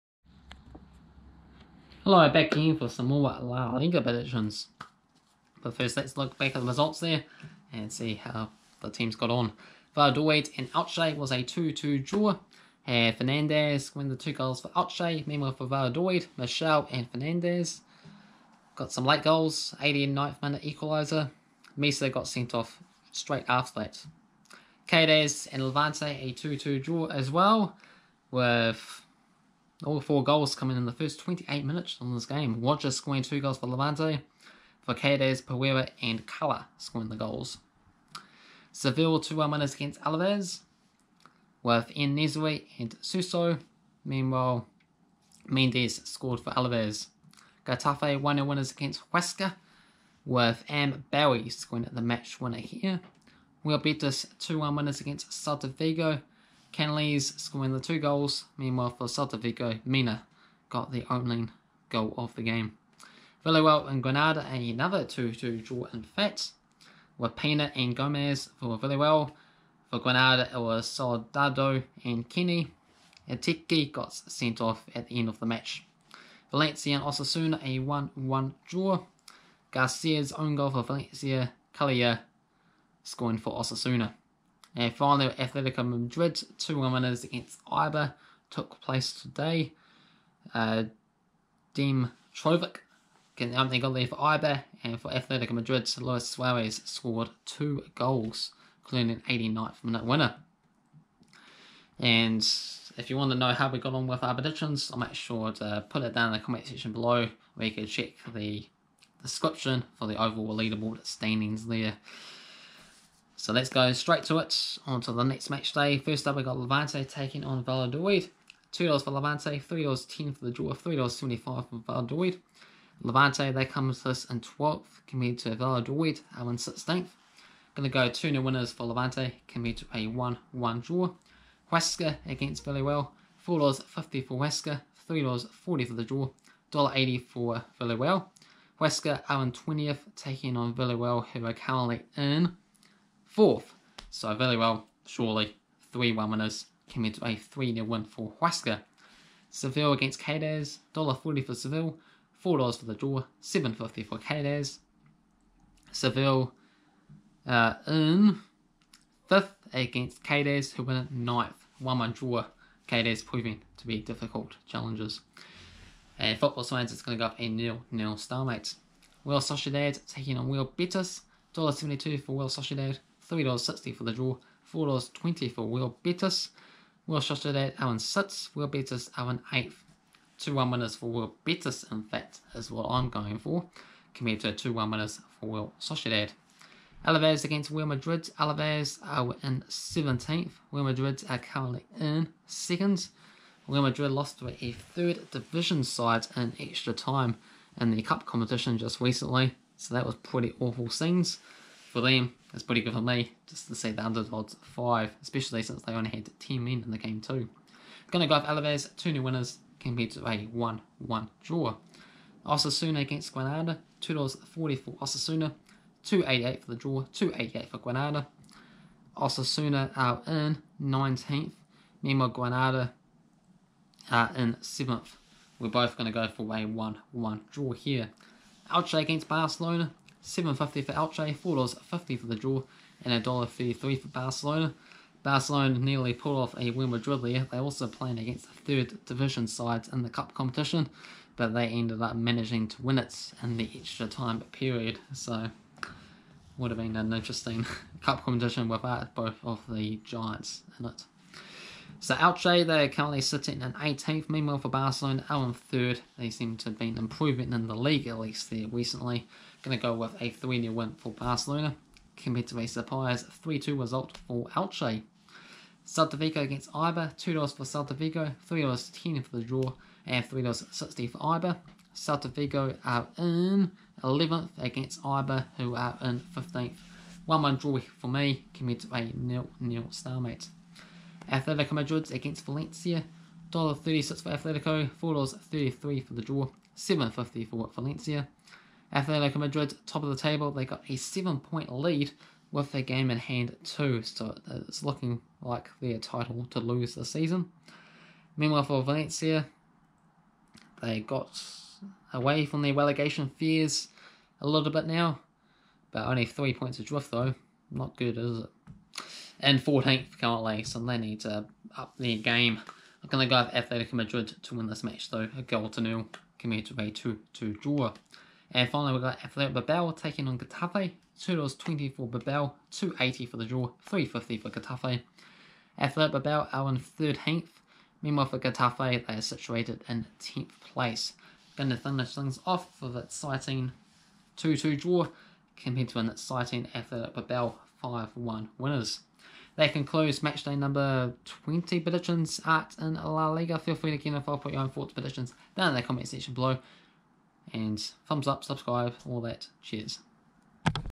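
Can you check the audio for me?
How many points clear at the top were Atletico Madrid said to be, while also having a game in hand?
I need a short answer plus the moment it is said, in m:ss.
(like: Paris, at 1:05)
7, at 4:50.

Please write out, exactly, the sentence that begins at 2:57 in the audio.
Real Sociedad, Alan 6th, Real Betis Alan 8th.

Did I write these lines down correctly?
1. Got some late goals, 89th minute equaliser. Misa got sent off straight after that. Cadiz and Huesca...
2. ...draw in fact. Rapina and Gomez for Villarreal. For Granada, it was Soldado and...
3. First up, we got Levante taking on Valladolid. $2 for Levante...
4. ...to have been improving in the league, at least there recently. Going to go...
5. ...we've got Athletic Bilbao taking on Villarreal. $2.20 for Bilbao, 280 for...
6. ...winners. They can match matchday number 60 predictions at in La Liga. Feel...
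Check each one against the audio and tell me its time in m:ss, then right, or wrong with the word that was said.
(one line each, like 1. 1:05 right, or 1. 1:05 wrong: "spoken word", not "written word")
1. 0:18 wrong: "Levante", not "Huesca"
2. 1:05 right
3. 1:55 right
4. 4:16 right
5. 5:18 wrong: "Getafe", not "Villarreal"
6. 5:38 wrong: "20", not "60".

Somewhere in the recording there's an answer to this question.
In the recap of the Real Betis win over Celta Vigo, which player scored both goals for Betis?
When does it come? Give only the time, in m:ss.
0:56.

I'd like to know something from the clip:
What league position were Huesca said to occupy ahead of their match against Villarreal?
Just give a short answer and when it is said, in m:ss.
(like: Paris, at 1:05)
20th, at 2:19.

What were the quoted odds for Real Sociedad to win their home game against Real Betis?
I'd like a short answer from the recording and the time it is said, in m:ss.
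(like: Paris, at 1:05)
$1.72, at 2:51.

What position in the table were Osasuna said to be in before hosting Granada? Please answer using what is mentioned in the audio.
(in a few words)
19th.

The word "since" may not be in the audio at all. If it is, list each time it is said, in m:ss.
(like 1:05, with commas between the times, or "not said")
3:25.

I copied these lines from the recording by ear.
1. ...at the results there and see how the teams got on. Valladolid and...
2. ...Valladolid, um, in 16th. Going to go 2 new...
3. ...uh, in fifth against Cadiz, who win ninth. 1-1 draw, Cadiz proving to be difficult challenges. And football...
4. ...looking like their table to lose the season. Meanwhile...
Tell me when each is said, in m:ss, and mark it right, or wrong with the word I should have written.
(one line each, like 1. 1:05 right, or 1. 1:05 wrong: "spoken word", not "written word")
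1. 0:06 right
2. 2:05 right
3. 2:37 right
4. 4:54 wrong: "title", not "table".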